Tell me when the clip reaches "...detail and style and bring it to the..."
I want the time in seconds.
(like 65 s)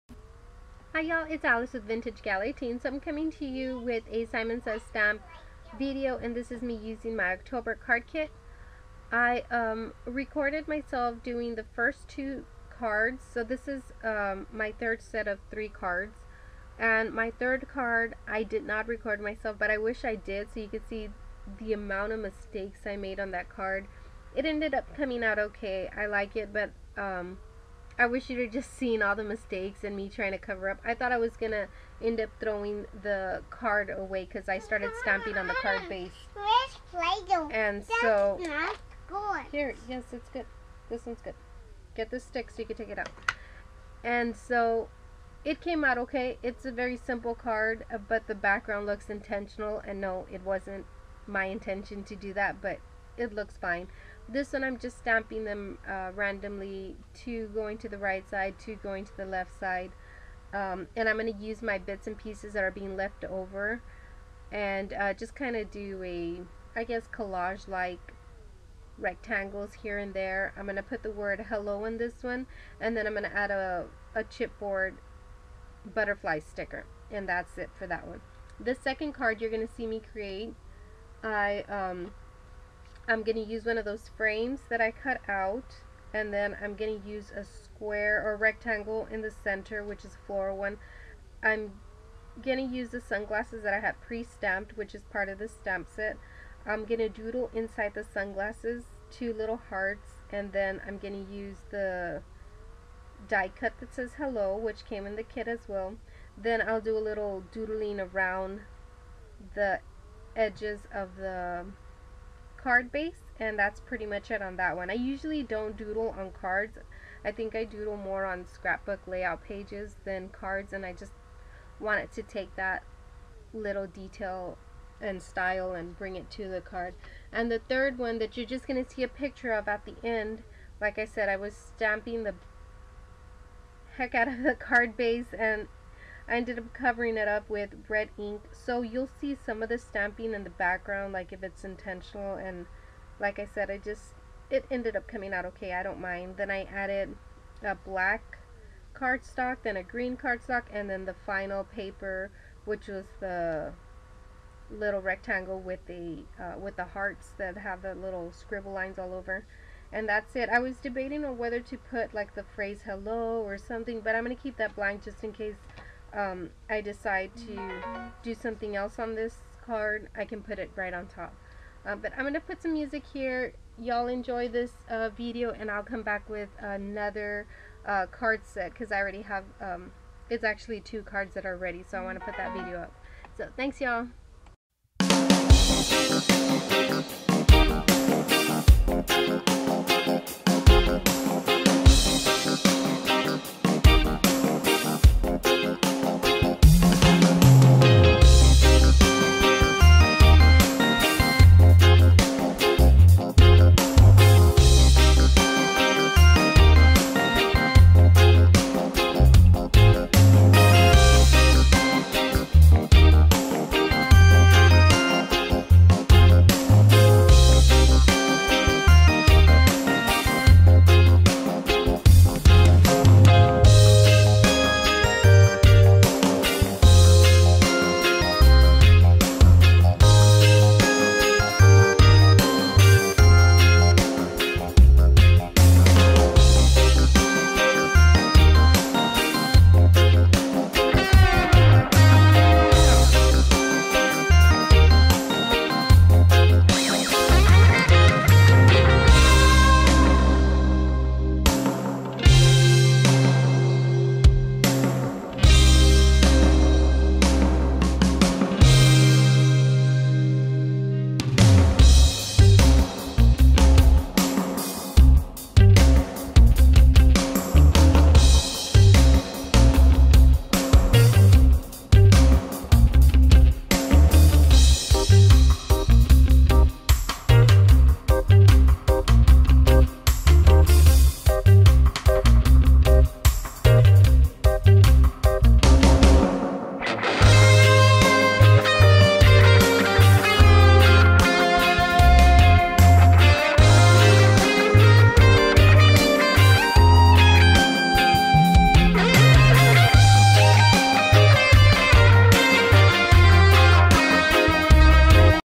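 123 s.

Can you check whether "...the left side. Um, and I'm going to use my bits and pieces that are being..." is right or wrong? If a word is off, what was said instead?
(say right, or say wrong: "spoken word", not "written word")
right.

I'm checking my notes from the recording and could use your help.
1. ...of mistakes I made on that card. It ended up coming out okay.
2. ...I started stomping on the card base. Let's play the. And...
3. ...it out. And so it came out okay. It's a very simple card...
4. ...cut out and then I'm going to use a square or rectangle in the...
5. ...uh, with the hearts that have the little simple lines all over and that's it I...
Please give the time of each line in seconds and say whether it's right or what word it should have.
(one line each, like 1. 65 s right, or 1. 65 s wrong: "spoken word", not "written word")
1. 22 s right
2. 34 s right
3. 42 s right
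4. 84 s right
5. 156 s wrong: "scribble", not "simple".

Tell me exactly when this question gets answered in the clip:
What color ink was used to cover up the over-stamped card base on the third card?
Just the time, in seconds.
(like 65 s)
137 s.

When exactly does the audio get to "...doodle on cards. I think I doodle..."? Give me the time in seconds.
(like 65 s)
115 s.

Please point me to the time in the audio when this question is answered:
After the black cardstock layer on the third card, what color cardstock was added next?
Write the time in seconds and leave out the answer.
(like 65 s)
149 s.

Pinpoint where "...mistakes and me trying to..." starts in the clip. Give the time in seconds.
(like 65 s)
29 s.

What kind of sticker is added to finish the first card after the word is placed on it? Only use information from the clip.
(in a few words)
chipboard butterfly sticker.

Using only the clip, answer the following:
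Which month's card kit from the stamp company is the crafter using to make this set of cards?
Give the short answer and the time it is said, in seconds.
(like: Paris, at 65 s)
October, at 7 s.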